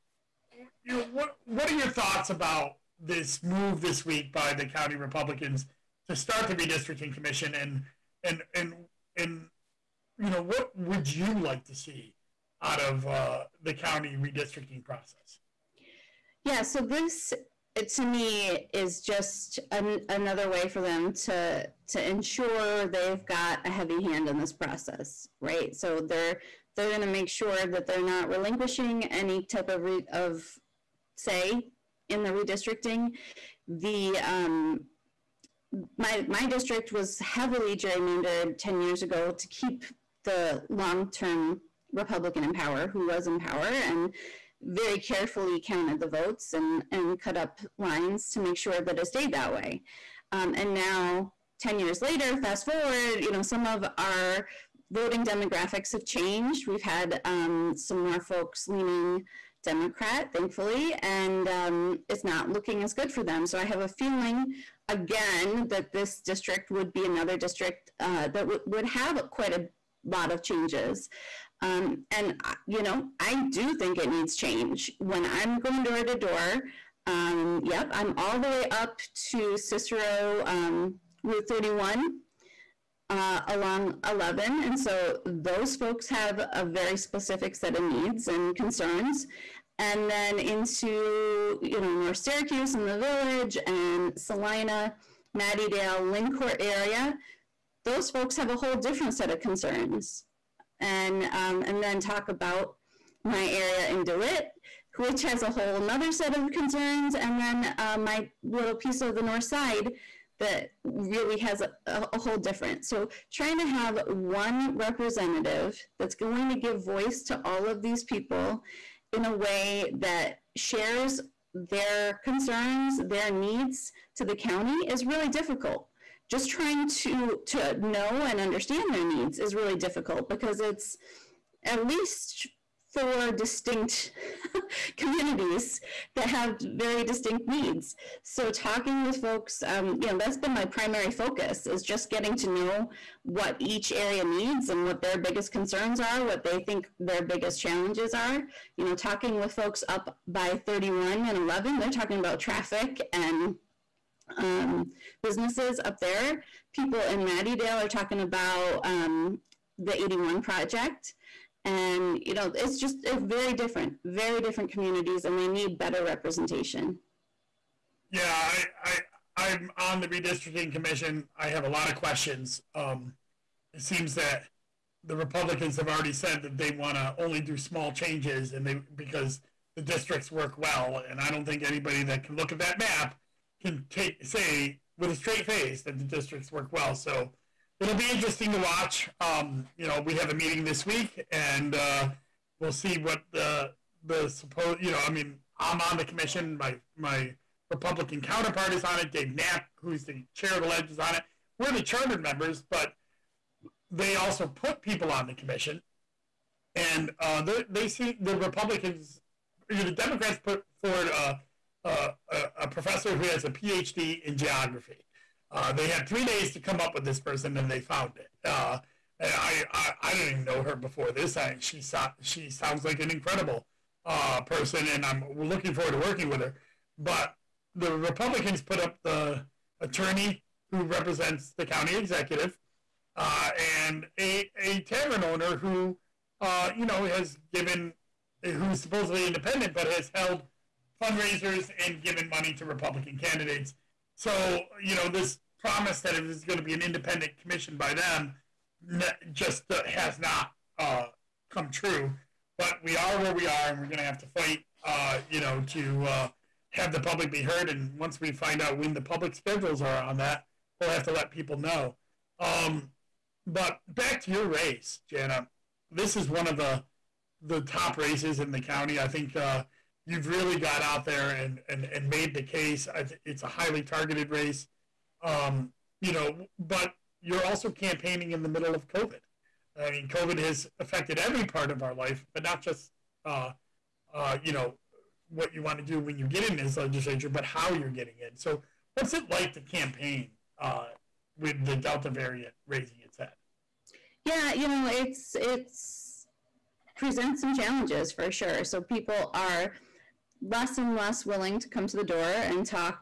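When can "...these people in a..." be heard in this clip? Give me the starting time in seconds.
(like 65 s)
117 s.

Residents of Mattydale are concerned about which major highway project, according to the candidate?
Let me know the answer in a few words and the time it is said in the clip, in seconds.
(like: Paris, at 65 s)
The 81 project, at 159 s.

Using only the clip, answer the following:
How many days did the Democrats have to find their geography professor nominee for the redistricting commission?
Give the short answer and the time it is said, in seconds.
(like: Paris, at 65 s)
3 days, at 216 s.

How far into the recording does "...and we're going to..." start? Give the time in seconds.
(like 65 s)
253 s.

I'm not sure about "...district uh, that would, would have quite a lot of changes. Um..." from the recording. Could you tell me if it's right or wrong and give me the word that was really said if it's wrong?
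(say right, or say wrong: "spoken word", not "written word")
right.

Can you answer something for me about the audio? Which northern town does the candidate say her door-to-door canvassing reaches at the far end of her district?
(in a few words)
Cicero.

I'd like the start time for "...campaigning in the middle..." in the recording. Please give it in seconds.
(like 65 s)
277 s.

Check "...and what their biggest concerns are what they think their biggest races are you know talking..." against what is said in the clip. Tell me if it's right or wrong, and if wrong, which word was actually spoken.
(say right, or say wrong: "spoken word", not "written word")
wrong: "challenges", not "races".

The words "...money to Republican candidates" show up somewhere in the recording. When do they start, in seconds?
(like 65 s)
242 s.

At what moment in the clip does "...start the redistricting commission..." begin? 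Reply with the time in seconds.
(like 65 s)
6 s.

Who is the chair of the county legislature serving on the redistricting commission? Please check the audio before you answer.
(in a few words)
Dave Knapp.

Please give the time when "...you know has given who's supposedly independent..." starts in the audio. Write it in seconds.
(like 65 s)
236 s.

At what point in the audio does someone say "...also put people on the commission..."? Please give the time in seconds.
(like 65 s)
204 s.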